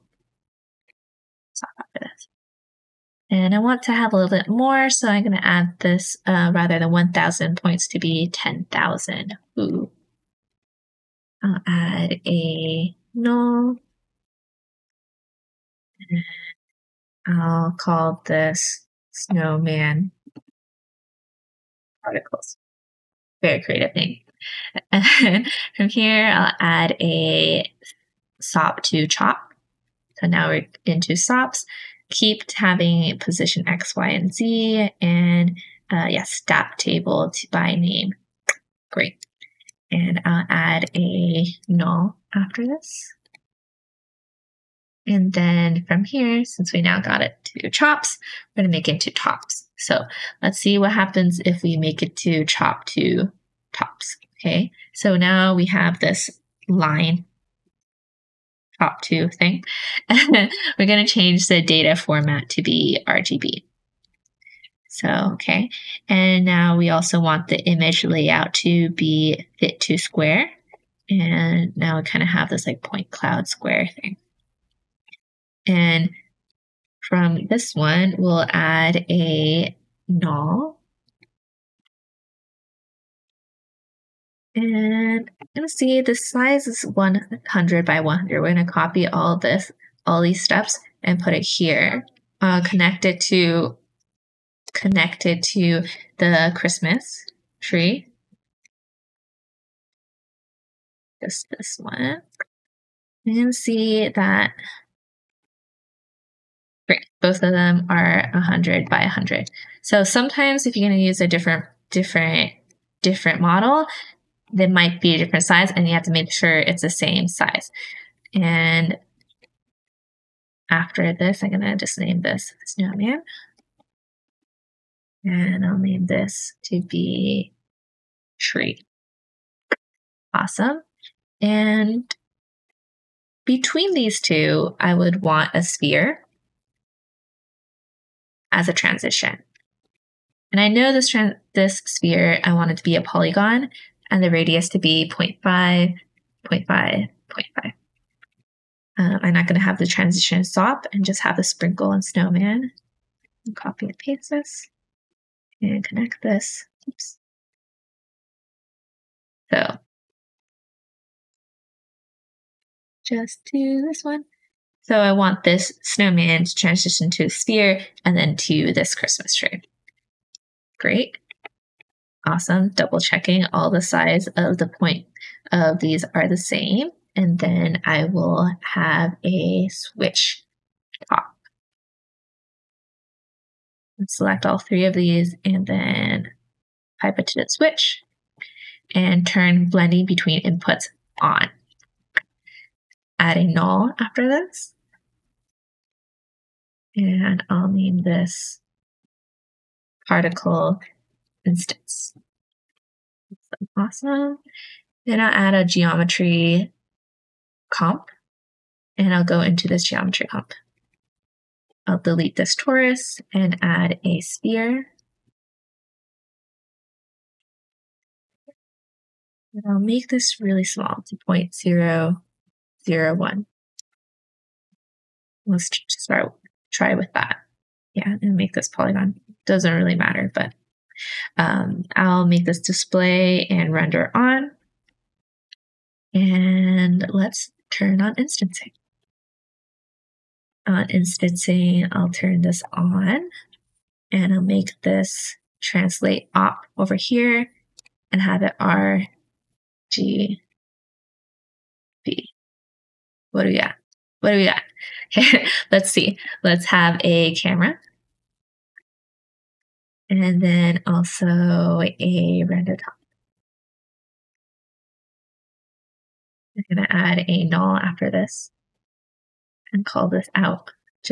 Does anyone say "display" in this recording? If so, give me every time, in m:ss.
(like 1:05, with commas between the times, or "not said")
3:52.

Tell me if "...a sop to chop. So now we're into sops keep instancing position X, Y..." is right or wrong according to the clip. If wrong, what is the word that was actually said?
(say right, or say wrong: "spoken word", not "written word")
wrong: "having", not "instancing".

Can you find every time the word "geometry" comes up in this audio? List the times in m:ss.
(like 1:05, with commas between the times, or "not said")
3:25, 3:29.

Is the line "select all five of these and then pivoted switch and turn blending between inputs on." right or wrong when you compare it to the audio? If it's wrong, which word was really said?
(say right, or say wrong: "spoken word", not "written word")
wrong: "three", not "five".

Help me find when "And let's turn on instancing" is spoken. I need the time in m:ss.
3:56.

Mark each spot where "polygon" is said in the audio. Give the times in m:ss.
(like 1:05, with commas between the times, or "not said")
2:23, 3:48.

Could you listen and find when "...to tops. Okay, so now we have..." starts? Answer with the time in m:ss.
0:52.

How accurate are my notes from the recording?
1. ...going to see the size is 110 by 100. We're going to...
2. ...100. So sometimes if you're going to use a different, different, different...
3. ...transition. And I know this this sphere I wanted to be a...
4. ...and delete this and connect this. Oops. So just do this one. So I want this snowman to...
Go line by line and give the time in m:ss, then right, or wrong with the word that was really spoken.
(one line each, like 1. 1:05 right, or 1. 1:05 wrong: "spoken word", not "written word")
1. 1:25 wrong: "100", not "110"
2. 1:49 right
3. 2:18 right
4. 2:33 wrong: "paste", not "delete".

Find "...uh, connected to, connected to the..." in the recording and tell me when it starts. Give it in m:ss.
1:32.